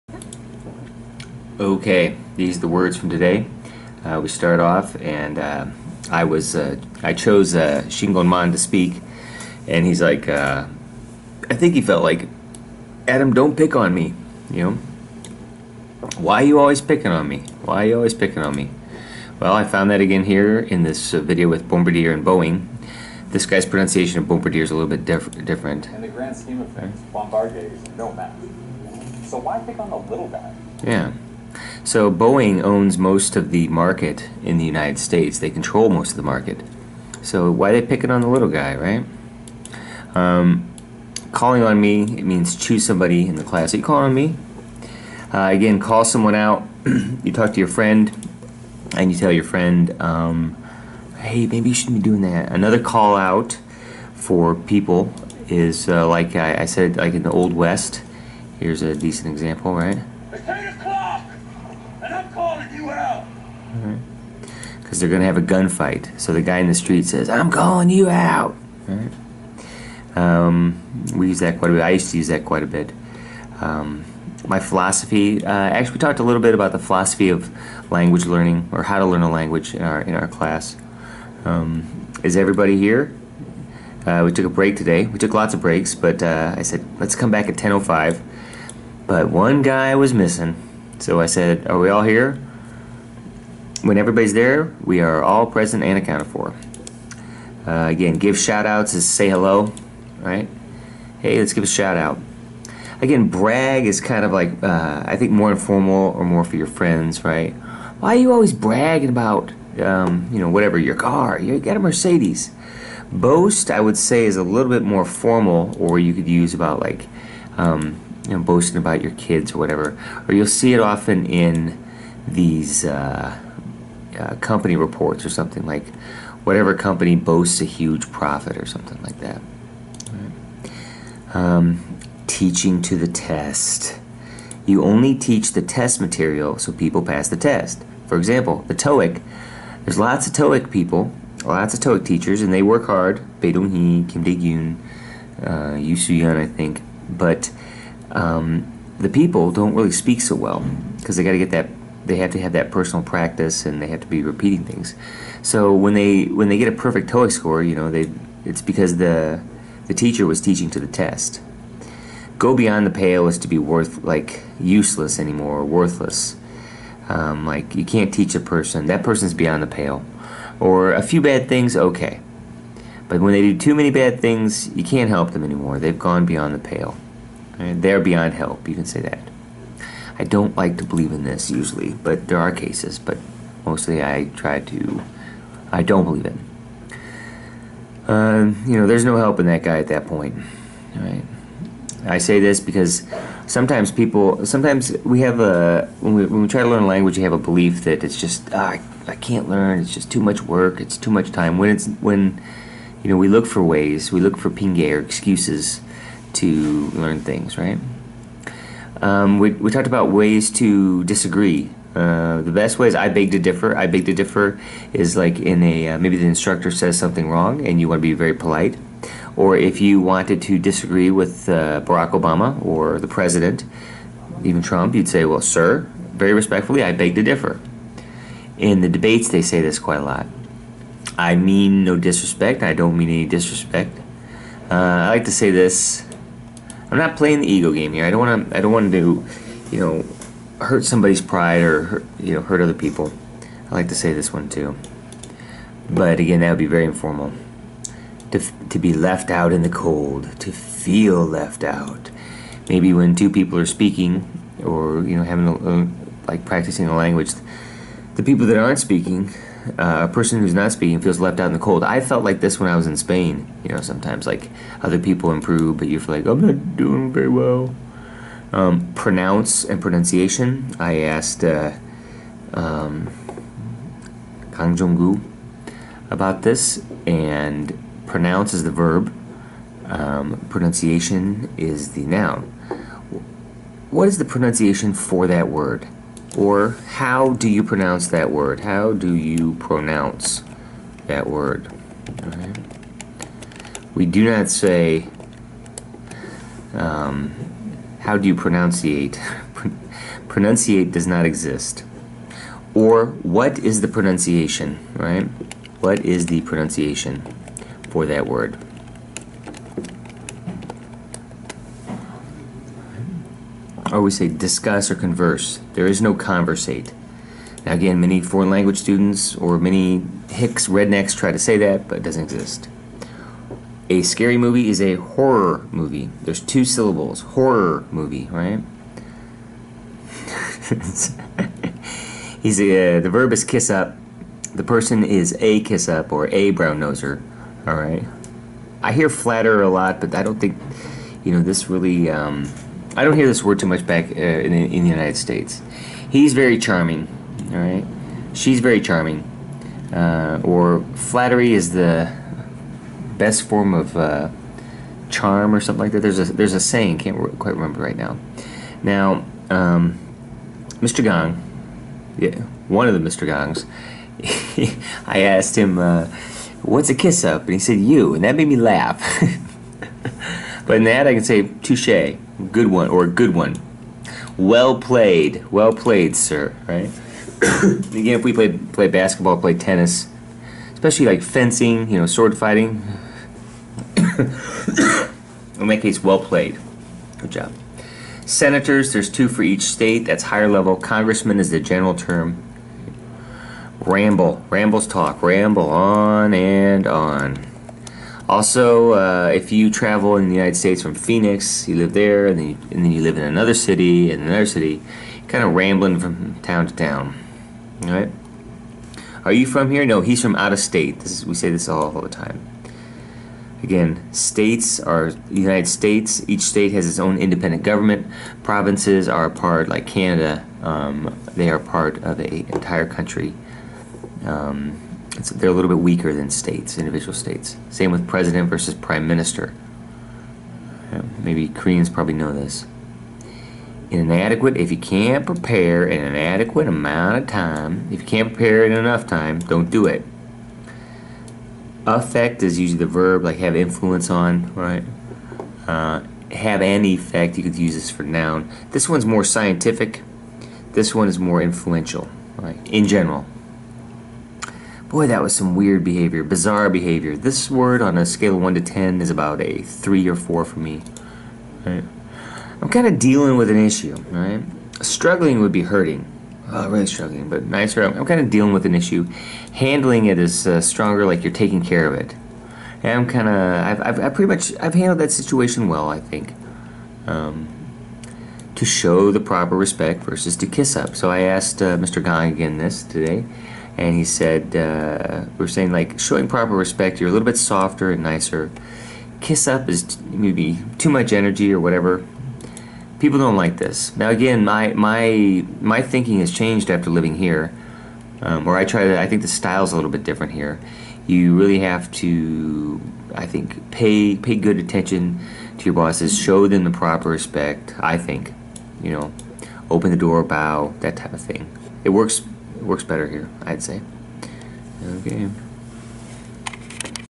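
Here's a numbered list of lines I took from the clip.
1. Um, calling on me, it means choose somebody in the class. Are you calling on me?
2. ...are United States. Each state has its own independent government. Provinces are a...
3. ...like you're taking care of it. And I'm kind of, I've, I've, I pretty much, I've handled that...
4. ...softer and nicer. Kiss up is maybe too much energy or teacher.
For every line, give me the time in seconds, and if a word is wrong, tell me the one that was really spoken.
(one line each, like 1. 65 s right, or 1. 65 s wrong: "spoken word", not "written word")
1. 40 s right
2. 414 s right
3. 471 s right
4. 487 s wrong: "whatever", not "teacher".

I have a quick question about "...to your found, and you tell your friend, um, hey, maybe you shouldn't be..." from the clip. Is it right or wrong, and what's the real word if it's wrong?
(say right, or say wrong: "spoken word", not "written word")
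wrong: "friend", not "found".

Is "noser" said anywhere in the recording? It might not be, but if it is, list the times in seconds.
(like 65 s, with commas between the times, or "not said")
336 s.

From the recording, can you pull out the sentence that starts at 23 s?
This guy's pronunciation of Bombardier is a little bit diff different.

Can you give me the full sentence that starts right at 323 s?
A scary movie is a horror movie.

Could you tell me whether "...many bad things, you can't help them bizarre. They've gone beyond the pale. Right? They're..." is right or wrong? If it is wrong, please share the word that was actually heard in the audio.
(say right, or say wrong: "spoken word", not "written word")
wrong: "anymore", not "bizarre".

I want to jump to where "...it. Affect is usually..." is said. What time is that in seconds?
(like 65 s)
439 s.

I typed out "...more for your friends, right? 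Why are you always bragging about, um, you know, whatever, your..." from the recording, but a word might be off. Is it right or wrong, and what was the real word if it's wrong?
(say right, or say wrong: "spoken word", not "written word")
right.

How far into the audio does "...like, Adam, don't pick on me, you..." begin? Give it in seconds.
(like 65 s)
12 s.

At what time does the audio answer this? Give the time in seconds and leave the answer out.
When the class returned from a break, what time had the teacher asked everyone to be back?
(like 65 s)
87 s.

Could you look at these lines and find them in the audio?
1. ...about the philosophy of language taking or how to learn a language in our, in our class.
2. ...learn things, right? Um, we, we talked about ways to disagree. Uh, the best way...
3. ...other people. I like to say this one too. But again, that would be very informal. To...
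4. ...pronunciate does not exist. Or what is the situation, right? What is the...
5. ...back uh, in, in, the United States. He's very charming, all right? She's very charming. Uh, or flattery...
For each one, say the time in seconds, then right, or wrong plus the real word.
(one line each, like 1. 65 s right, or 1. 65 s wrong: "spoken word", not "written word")
1. 76 s wrong: "learning", not "taking"
2. 206 s right
3. 242 s right
4. 300 s wrong: "pronunciation", not "situation"
5. 343 s right.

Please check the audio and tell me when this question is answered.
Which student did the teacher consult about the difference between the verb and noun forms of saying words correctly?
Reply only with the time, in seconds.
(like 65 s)
274 s.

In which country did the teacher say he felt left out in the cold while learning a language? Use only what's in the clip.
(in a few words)
Spain.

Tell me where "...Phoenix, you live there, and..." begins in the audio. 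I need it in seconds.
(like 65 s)
400 s.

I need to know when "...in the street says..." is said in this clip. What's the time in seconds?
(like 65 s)
66 s.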